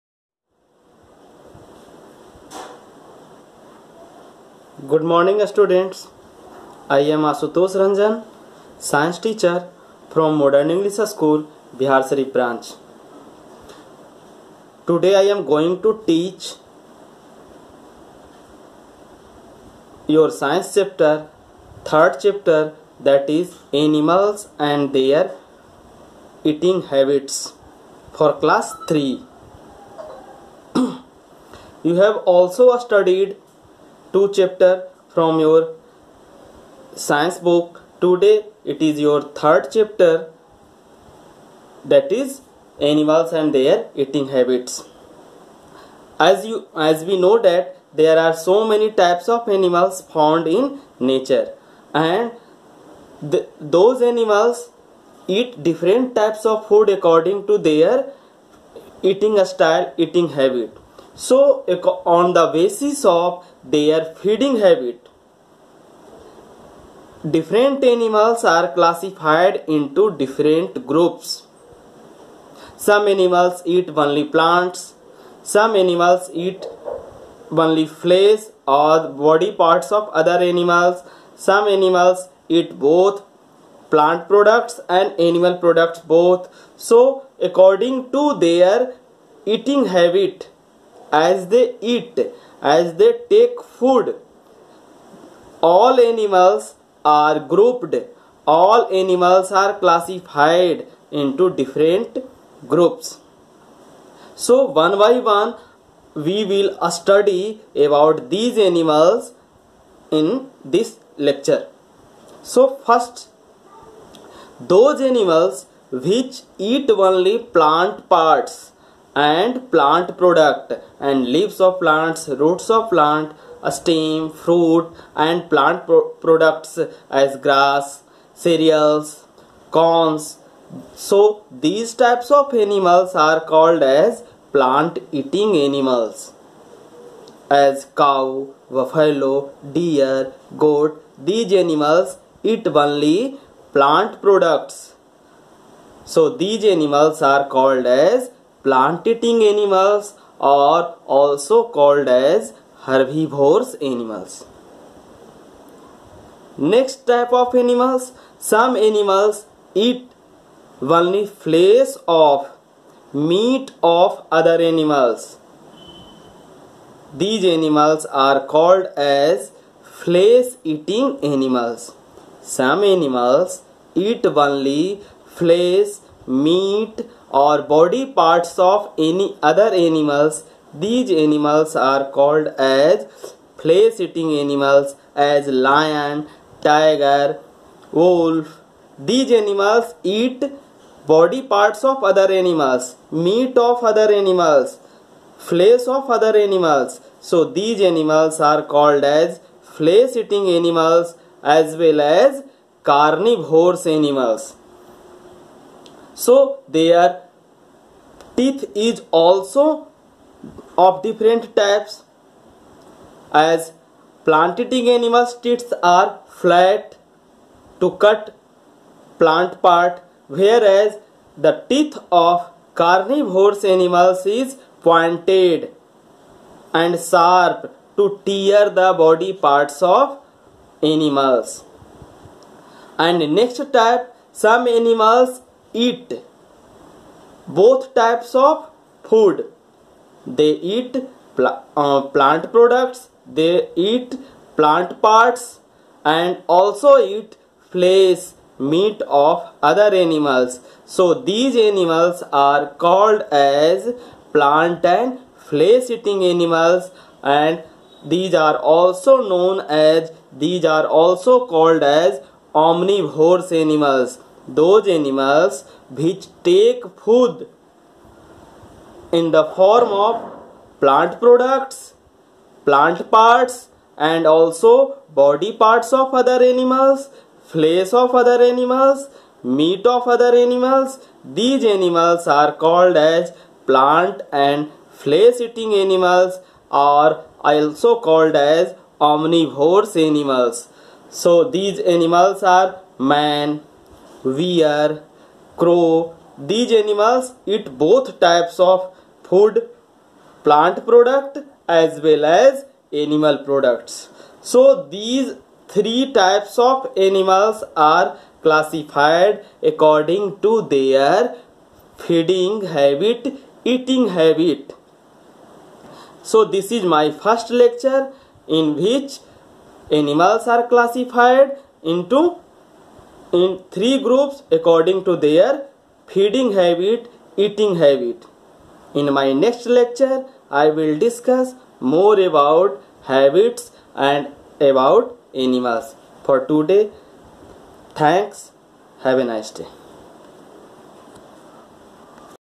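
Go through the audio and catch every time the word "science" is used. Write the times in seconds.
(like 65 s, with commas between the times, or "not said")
8 s, 20 s, 36 s.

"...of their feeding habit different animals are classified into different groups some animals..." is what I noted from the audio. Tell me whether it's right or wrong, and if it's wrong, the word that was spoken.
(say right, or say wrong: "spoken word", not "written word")
right.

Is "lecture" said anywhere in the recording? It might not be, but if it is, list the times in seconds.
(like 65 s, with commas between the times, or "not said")
111 s, 317 s, 329 s.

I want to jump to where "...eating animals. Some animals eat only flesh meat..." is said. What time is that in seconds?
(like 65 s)
170 s.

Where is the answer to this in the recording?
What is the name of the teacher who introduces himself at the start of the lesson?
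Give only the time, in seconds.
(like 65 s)
7 s.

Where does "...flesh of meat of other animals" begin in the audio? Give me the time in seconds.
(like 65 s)
161 s.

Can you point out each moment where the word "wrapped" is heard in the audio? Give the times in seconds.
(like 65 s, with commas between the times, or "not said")
not said.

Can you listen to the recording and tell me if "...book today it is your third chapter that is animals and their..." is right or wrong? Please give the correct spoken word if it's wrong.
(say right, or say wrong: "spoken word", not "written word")
right.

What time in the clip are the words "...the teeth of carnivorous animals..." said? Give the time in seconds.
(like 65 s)
221 s.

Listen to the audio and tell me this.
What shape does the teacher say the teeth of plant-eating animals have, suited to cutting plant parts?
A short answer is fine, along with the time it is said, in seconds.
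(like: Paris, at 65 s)
flat, at 216 s.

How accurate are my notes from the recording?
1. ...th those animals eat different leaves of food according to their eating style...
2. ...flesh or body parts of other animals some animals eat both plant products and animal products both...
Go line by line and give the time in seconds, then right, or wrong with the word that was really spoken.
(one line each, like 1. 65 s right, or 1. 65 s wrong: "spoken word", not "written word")
1. 53 s wrong: "types", not "leaves"
2. 77 s right.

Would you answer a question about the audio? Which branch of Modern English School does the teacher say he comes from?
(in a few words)
Bihar Sari.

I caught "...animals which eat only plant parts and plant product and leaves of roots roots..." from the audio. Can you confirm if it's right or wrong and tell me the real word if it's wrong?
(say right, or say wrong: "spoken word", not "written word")
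wrong: "plants", not "roots".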